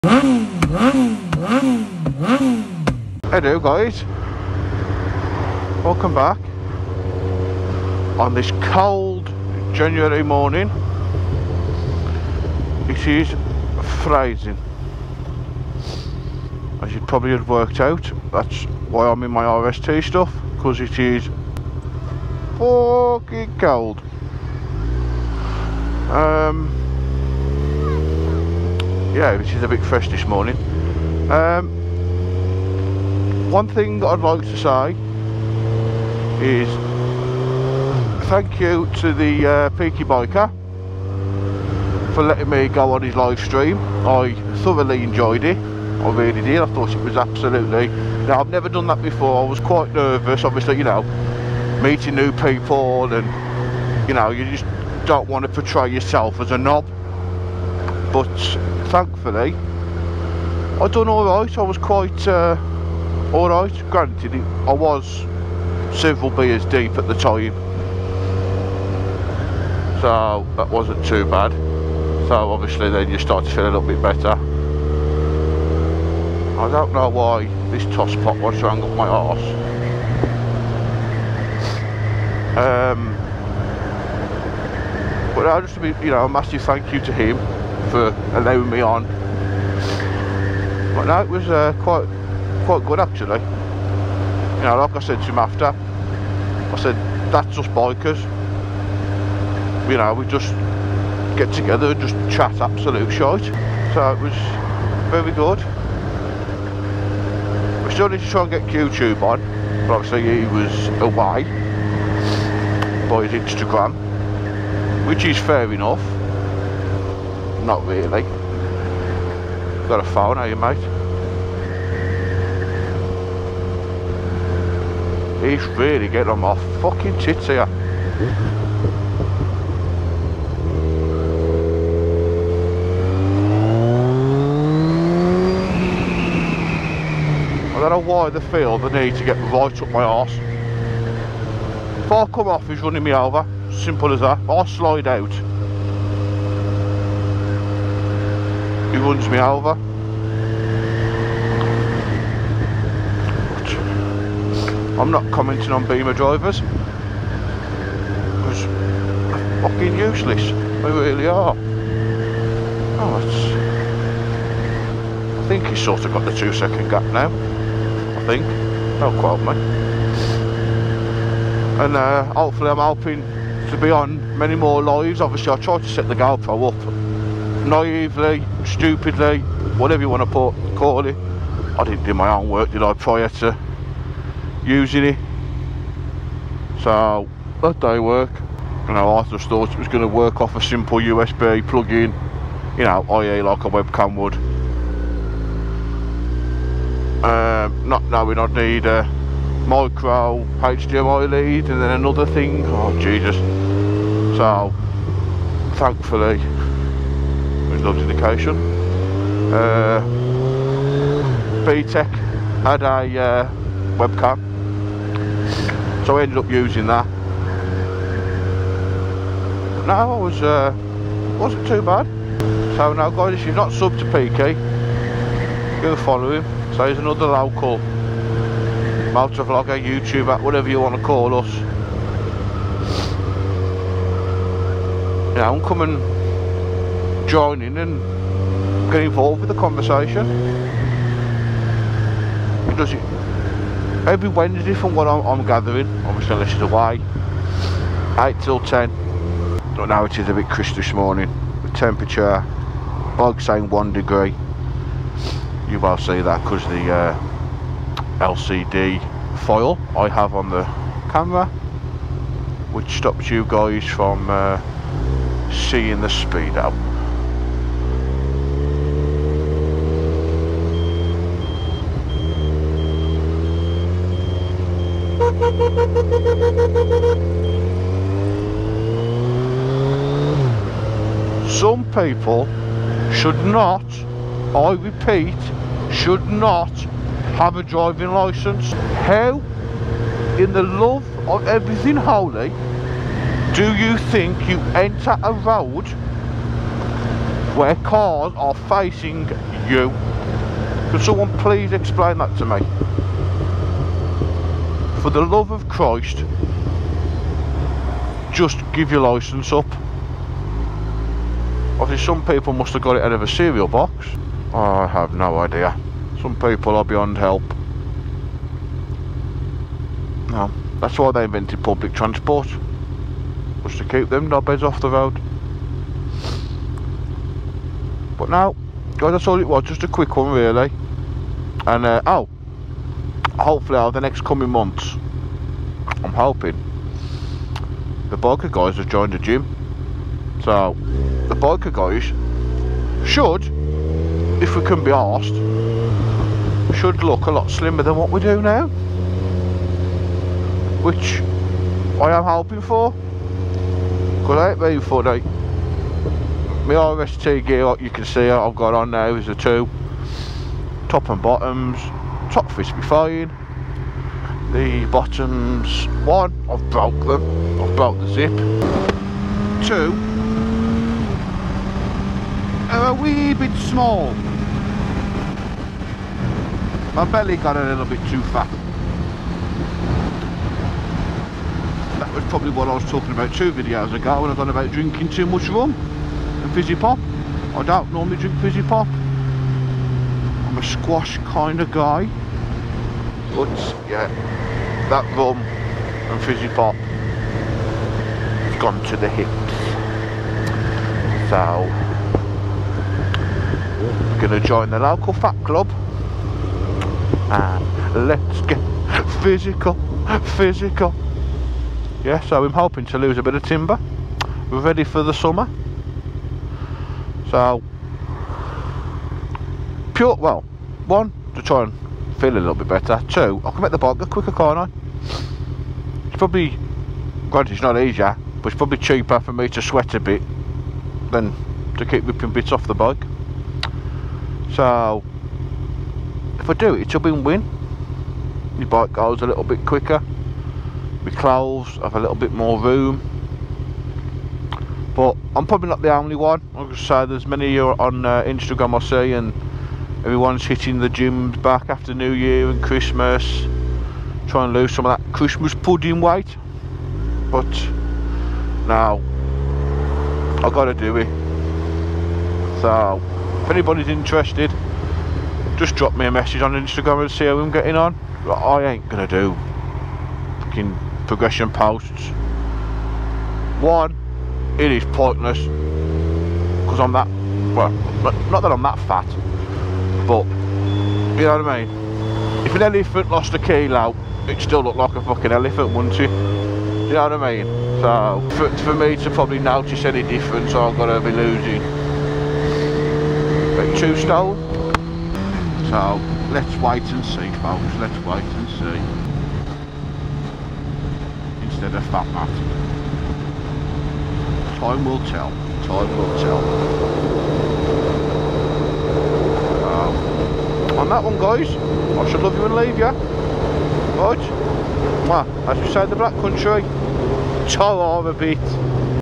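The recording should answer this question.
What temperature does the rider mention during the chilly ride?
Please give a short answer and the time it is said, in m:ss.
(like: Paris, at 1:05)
1 degree, at 4:13.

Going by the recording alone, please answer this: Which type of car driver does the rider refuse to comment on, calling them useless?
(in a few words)
Beamer drivers.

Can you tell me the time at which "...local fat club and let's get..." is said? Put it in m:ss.
6:44.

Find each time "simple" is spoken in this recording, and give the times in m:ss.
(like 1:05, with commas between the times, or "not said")
2:23, 3:10.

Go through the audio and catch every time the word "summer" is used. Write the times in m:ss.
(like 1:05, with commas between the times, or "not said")
6:55.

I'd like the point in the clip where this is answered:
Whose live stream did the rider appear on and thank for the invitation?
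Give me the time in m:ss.
0:39.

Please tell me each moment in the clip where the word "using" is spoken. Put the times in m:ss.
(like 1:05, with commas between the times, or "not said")
3:04, 3:36.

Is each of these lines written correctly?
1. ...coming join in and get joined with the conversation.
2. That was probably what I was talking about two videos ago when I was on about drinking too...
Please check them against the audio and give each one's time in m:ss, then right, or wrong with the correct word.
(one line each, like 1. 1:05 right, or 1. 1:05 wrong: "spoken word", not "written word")
1. 3:55 wrong: "involved", not "joined"
2. 6:21 right.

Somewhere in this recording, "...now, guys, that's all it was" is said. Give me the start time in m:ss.
5:28.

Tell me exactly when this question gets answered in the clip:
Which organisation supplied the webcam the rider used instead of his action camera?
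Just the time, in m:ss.
3:27.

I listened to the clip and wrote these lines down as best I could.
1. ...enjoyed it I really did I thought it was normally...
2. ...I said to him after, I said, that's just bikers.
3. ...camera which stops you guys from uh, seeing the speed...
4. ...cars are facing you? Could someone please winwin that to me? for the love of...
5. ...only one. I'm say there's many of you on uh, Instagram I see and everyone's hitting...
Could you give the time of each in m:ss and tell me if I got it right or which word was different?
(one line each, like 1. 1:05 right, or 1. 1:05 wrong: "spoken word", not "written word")
1. 0:45 wrong: "absolutely", not "normally"
2. 1:34 right
3. 4:21 right
4. 4:57 wrong: "explain", not "winwin"
5. 7:25 right.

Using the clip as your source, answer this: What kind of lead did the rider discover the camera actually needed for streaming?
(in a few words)
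micro HDMI.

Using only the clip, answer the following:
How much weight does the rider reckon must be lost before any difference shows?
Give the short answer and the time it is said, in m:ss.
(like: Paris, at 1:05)
2 stone, at 8:13.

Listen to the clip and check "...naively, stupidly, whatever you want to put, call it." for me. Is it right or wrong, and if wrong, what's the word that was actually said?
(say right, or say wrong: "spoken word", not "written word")
right.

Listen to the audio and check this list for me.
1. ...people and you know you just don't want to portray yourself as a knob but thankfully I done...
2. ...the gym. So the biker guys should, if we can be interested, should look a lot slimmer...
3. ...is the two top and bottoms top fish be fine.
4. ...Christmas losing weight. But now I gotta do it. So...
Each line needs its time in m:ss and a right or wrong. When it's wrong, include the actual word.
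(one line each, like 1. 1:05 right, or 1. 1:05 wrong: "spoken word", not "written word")
1. 0:52 right
2. 5:39 wrong: "asked", not "interested"
3. 5:59 right
4. 7:35 wrong: "pudding", not "losing".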